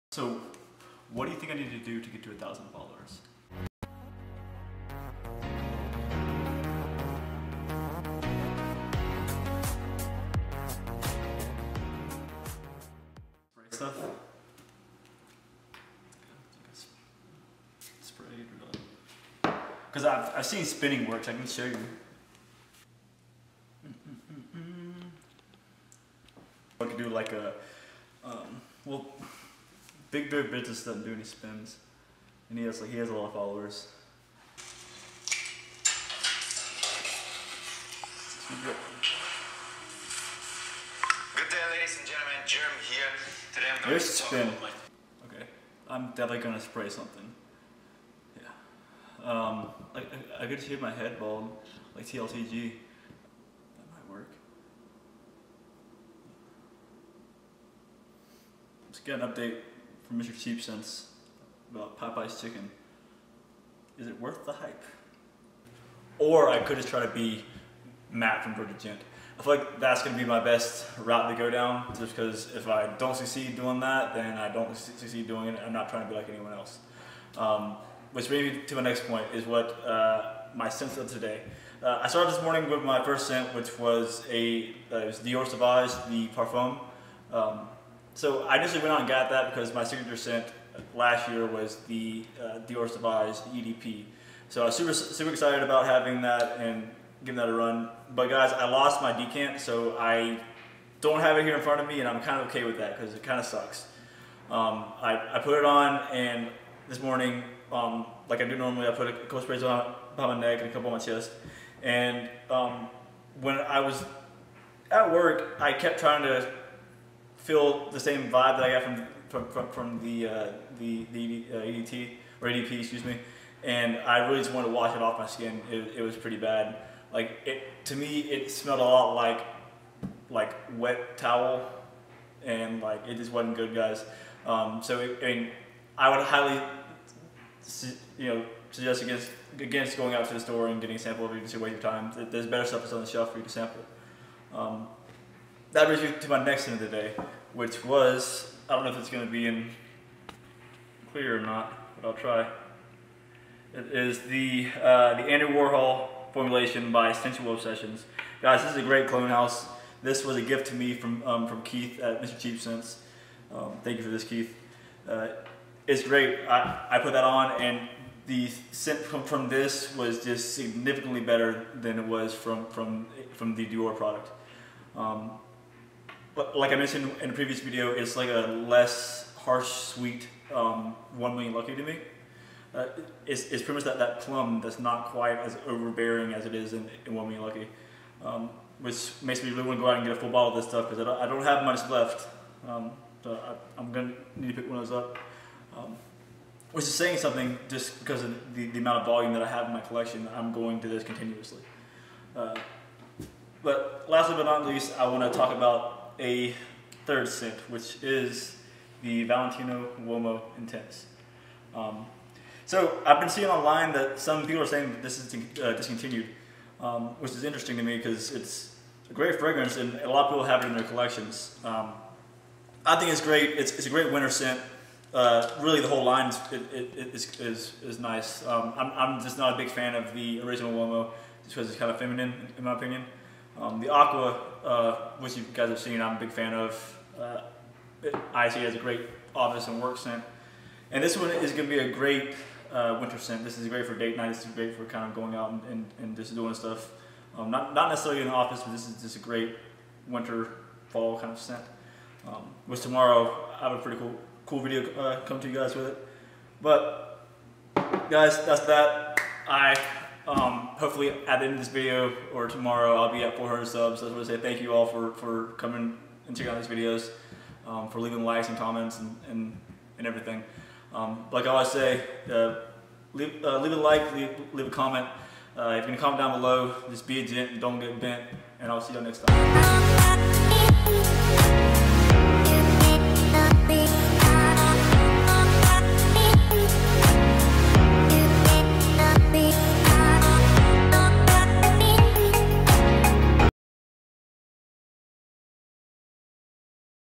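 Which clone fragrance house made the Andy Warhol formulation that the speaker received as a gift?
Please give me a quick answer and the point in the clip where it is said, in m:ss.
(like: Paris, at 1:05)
Sensual Obsessions, at 2:37.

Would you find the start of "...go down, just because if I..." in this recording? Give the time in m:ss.
1:11.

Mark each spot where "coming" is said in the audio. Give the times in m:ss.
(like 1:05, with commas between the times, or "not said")
4:25.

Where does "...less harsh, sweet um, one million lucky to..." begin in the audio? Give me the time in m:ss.
2:58.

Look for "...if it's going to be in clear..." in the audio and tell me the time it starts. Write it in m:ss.
2:28.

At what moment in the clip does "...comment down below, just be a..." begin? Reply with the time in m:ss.
4:36.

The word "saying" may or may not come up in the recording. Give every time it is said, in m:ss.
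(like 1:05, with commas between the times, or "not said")
3:16, 3:34.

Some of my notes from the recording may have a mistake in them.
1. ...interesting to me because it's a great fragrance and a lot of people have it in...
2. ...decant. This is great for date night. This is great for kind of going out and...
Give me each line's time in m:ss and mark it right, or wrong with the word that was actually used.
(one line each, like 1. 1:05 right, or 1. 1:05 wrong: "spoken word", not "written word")
1. 3:37 right
2. 4:03 wrong: "scent", not "decant".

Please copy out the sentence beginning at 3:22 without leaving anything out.
Uh, but lastly but not least, I want to talk about a third scent, which is the Valentino Uomo Intense.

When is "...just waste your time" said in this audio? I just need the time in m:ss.
2:21.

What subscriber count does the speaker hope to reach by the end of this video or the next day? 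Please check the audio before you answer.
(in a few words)
400.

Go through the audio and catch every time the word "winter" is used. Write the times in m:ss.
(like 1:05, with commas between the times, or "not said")
3:44, 4:02, 4:10.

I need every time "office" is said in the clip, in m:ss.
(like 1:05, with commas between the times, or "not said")
3:59, 4:08.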